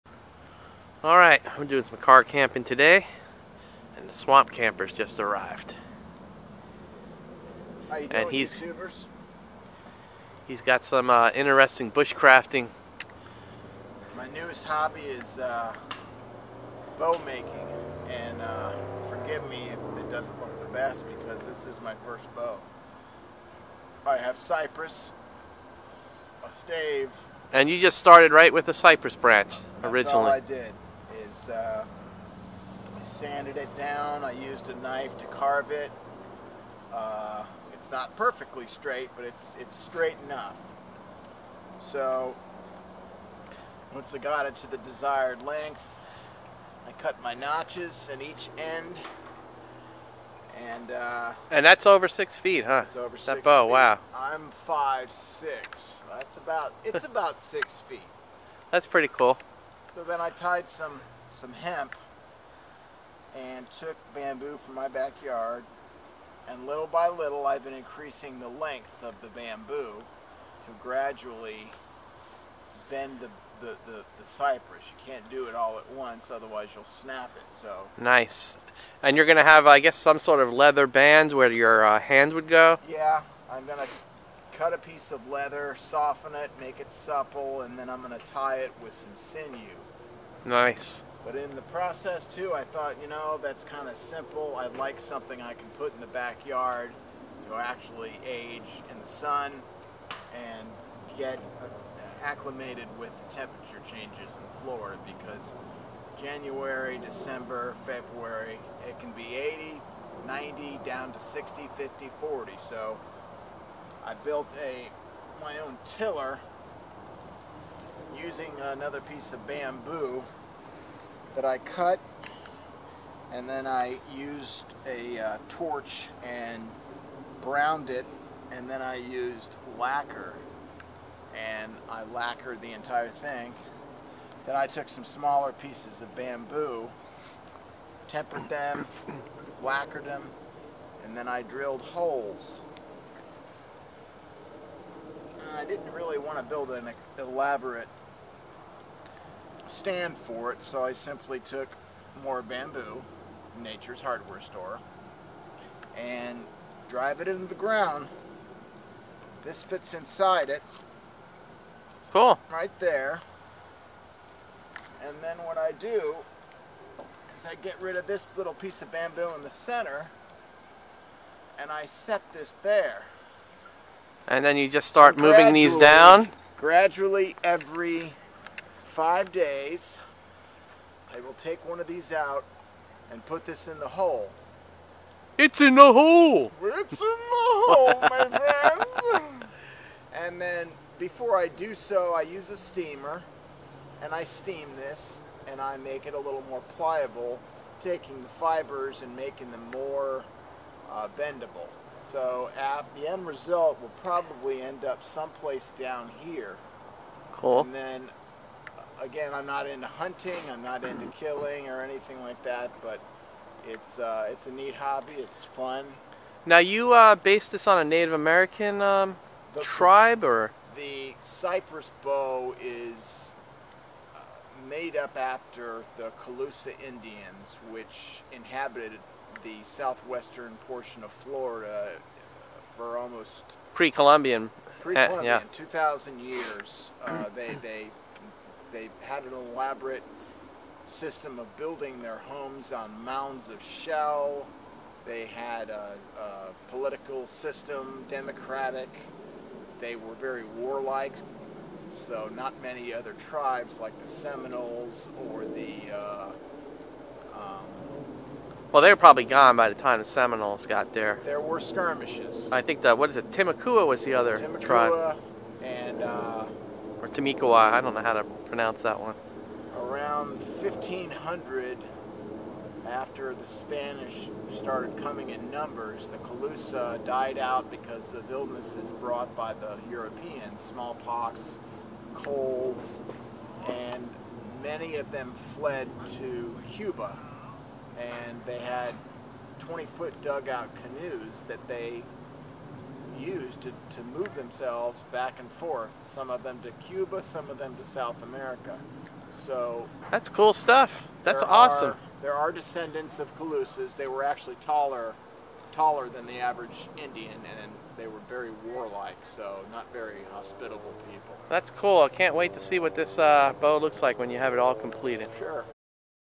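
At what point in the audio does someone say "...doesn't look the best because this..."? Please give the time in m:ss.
0:20.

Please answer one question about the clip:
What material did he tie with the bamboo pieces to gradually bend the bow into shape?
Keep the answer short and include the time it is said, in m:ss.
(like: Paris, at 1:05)
Hemp, at 1:01.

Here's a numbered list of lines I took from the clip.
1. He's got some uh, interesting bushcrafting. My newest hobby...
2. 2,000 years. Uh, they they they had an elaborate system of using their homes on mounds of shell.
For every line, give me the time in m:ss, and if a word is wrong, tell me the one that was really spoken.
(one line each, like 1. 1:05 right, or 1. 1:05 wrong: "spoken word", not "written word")
1. 0:10 right
2. 3:55 wrong: "building", not "using".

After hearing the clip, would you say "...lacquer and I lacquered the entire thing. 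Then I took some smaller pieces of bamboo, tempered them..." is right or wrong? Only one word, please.
right.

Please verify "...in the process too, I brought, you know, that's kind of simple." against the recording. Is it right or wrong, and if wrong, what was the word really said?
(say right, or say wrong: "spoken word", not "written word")
wrong: "thought", not "brought".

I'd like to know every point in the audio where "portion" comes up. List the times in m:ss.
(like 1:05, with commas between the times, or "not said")
3:50.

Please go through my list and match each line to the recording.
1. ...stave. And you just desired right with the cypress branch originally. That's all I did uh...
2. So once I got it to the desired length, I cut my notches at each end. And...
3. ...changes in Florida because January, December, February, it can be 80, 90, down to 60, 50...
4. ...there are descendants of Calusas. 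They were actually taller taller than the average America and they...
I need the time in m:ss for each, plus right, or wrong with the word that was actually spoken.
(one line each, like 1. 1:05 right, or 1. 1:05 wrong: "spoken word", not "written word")
1. 0:26 wrong: "started", not "desired"
2. 0:41 right
3. 1:43 right
4. 5:02 wrong: "Indian", not "America".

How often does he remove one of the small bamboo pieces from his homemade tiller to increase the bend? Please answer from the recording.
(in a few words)
Every 5 days.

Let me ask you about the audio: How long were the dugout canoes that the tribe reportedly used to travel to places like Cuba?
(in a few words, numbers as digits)
20 feet.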